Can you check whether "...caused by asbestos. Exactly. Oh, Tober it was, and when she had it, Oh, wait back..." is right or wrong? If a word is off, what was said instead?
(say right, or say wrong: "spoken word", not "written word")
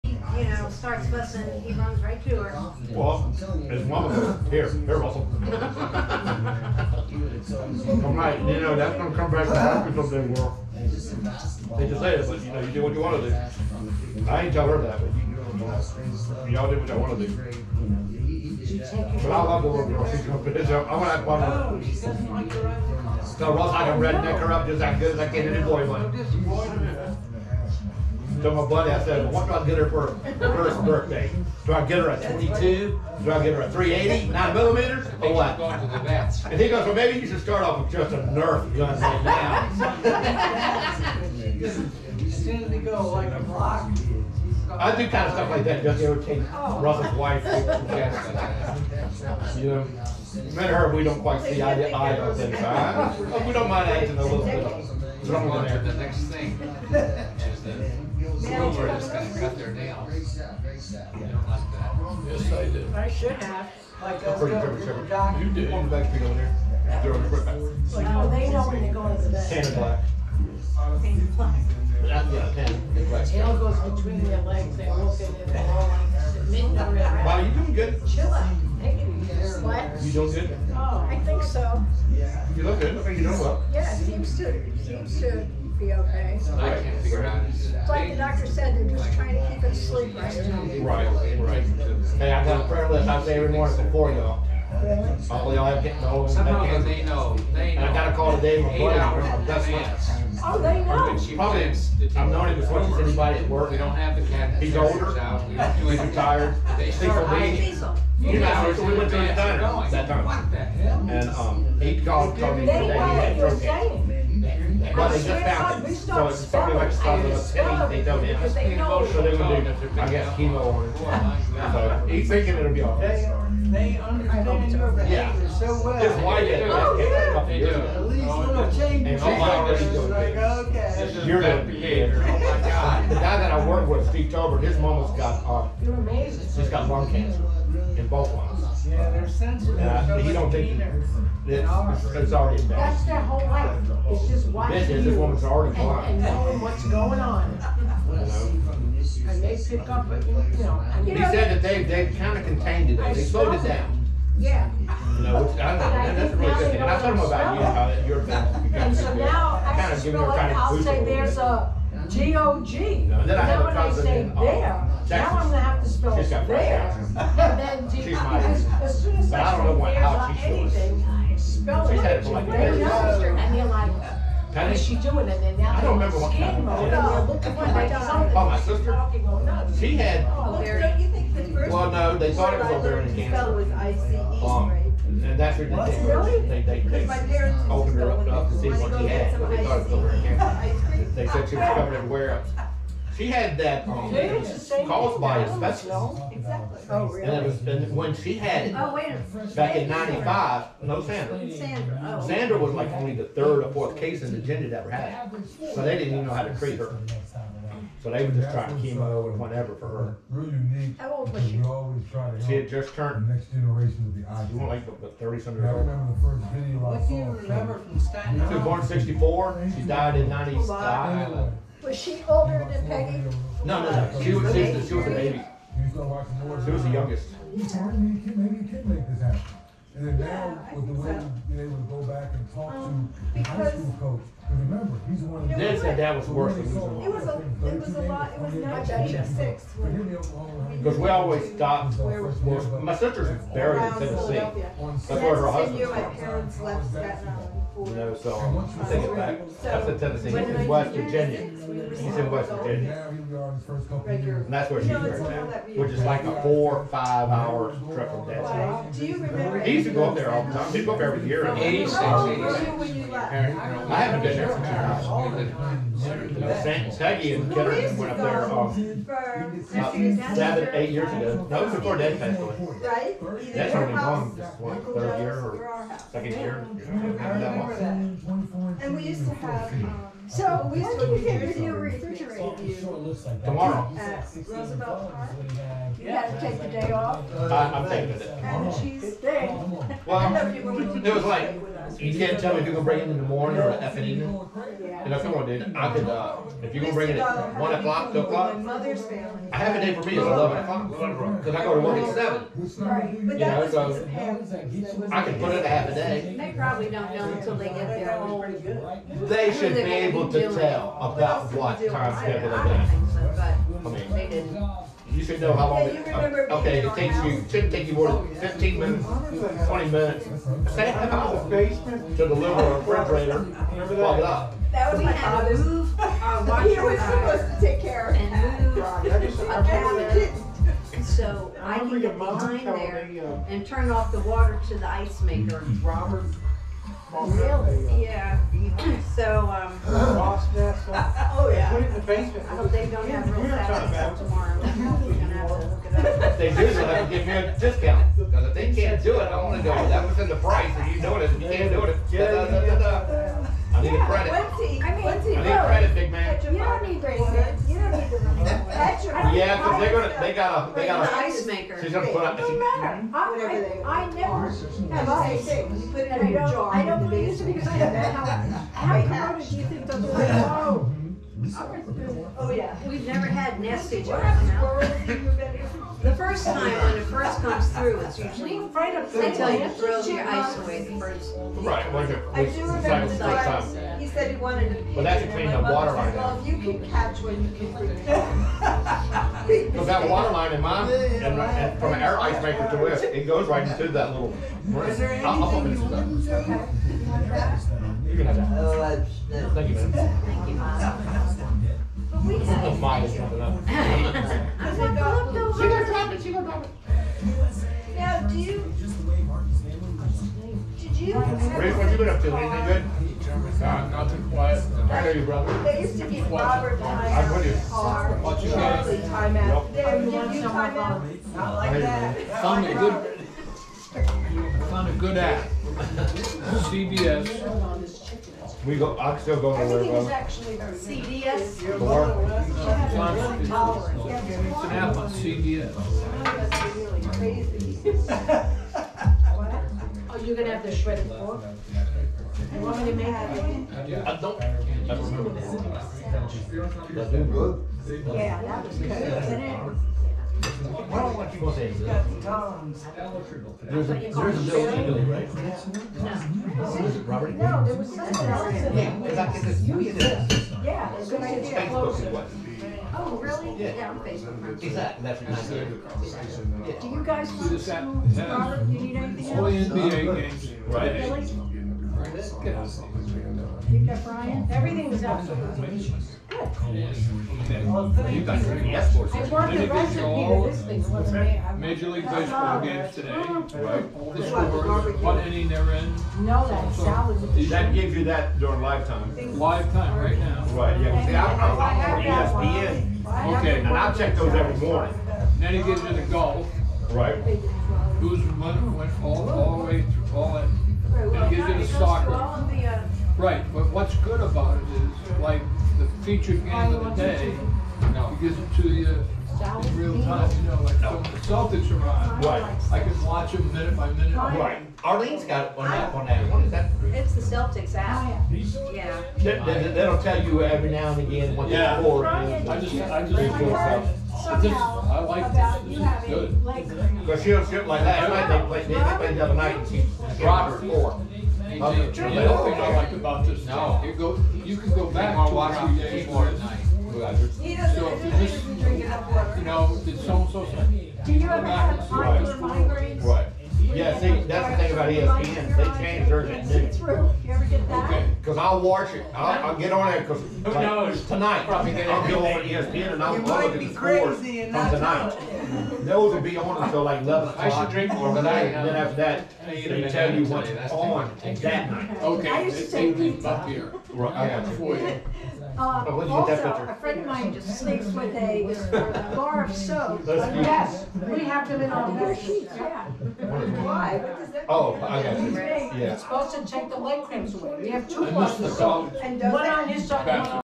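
wrong: "And", not "Tober".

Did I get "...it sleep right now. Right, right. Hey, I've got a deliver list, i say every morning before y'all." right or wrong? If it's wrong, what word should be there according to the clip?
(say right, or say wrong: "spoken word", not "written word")
wrong: "prayer", not "deliver".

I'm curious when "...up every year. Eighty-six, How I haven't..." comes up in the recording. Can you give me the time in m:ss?
4:20.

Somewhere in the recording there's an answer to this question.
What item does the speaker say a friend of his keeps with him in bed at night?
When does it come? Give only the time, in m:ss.
9:29.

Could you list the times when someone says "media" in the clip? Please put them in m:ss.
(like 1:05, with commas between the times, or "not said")
not said.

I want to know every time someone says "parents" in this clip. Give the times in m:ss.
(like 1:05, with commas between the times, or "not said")
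3:07, 4:06.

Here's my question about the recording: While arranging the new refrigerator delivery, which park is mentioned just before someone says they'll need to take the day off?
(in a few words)
Roosevelt Park.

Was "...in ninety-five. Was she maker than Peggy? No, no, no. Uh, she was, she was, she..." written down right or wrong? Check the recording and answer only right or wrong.
wrong.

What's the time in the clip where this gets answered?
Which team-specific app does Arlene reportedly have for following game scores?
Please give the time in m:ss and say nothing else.
8:37.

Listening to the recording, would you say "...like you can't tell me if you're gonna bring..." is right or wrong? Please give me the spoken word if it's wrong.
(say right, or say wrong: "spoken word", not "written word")
right.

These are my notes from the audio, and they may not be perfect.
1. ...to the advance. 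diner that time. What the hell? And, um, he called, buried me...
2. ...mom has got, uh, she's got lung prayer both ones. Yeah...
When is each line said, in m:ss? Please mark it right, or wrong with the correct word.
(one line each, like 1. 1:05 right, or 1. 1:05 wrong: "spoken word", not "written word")
1. 1:49 wrong: "called", not "buried"
2. 2:14 wrong: "cancer", not "prayer".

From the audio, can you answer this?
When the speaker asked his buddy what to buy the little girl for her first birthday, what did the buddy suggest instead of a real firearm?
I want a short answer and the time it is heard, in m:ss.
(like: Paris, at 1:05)
Nerf gun, at 0:38.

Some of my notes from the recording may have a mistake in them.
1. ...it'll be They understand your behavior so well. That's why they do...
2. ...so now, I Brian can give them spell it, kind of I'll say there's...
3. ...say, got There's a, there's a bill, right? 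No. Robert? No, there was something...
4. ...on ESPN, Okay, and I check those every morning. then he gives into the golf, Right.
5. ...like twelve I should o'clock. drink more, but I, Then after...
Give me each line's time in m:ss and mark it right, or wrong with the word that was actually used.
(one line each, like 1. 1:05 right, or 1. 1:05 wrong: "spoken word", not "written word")
1. 2:02 right
2. 2:38 wrong: "Kinda", not "Brian"
3. 7:31 right
4. 8:12 right
5. 9:16 wrong: "eleven", not "twelve".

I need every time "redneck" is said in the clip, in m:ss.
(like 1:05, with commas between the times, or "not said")
0:23.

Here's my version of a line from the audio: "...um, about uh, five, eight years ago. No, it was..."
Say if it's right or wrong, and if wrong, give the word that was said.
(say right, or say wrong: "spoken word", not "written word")
wrong: "seven", not "five".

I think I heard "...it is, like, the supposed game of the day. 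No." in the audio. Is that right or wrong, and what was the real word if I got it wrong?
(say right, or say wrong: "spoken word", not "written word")
wrong: "featured", not "supposed".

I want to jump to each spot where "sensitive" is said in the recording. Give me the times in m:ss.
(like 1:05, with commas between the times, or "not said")
2:19.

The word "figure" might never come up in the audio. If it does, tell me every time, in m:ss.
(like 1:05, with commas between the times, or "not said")
1:27, 4:41.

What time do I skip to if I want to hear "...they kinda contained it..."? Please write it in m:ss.
2:31.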